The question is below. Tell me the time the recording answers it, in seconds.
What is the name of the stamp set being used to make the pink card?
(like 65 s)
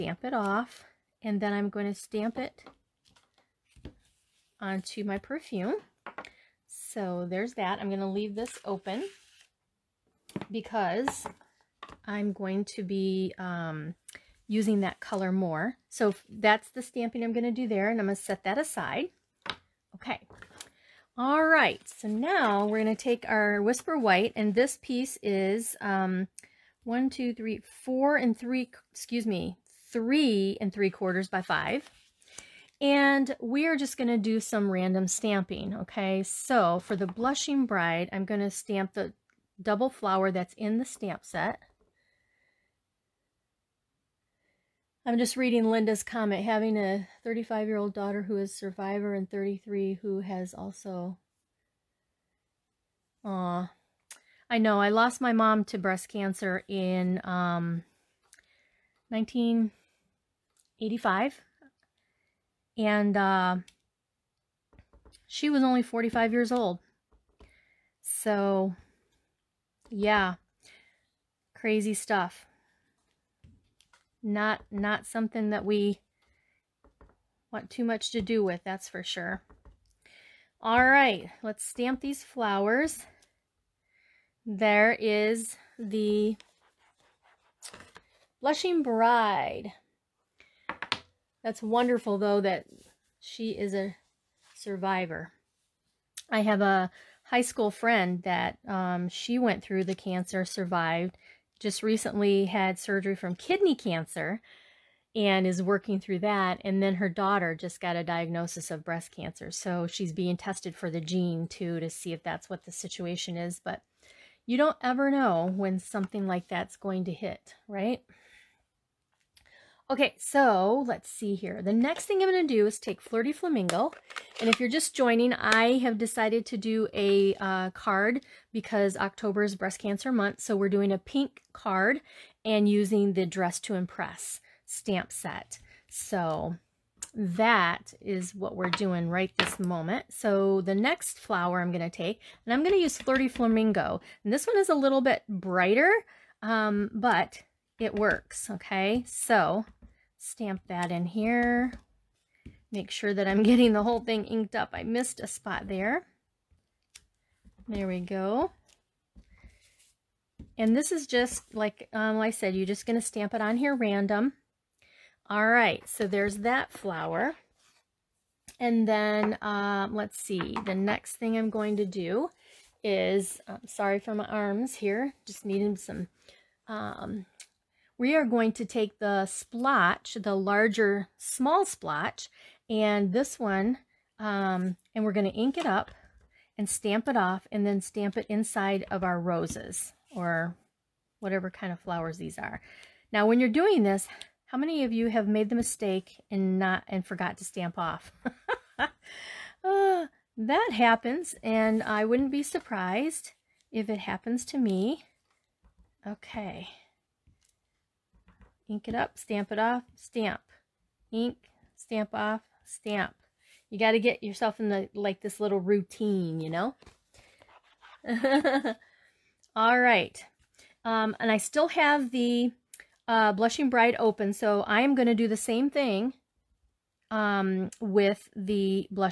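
133 s.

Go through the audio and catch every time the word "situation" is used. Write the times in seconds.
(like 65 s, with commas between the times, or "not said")
112 s.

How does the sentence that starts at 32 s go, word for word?
And we are just going to do some random stamping, okay?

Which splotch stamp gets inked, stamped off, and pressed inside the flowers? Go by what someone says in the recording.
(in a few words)
larger small splotch.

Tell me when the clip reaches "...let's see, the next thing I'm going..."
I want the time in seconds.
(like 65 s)
169 s.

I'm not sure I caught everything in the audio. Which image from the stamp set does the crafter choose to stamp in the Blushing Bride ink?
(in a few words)
double flower.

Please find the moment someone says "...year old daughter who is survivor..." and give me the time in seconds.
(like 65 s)
47 s.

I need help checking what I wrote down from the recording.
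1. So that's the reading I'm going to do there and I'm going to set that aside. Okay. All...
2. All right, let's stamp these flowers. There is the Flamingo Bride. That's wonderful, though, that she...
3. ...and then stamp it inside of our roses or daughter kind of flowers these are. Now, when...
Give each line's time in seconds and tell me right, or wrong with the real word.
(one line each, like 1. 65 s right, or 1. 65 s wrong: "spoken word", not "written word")
1. 15 s wrong: "stamping", not "reading"
2. 80 s wrong: "Blushing", not "Flamingo"
3. 187 s wrong: "whatever", not "daughter".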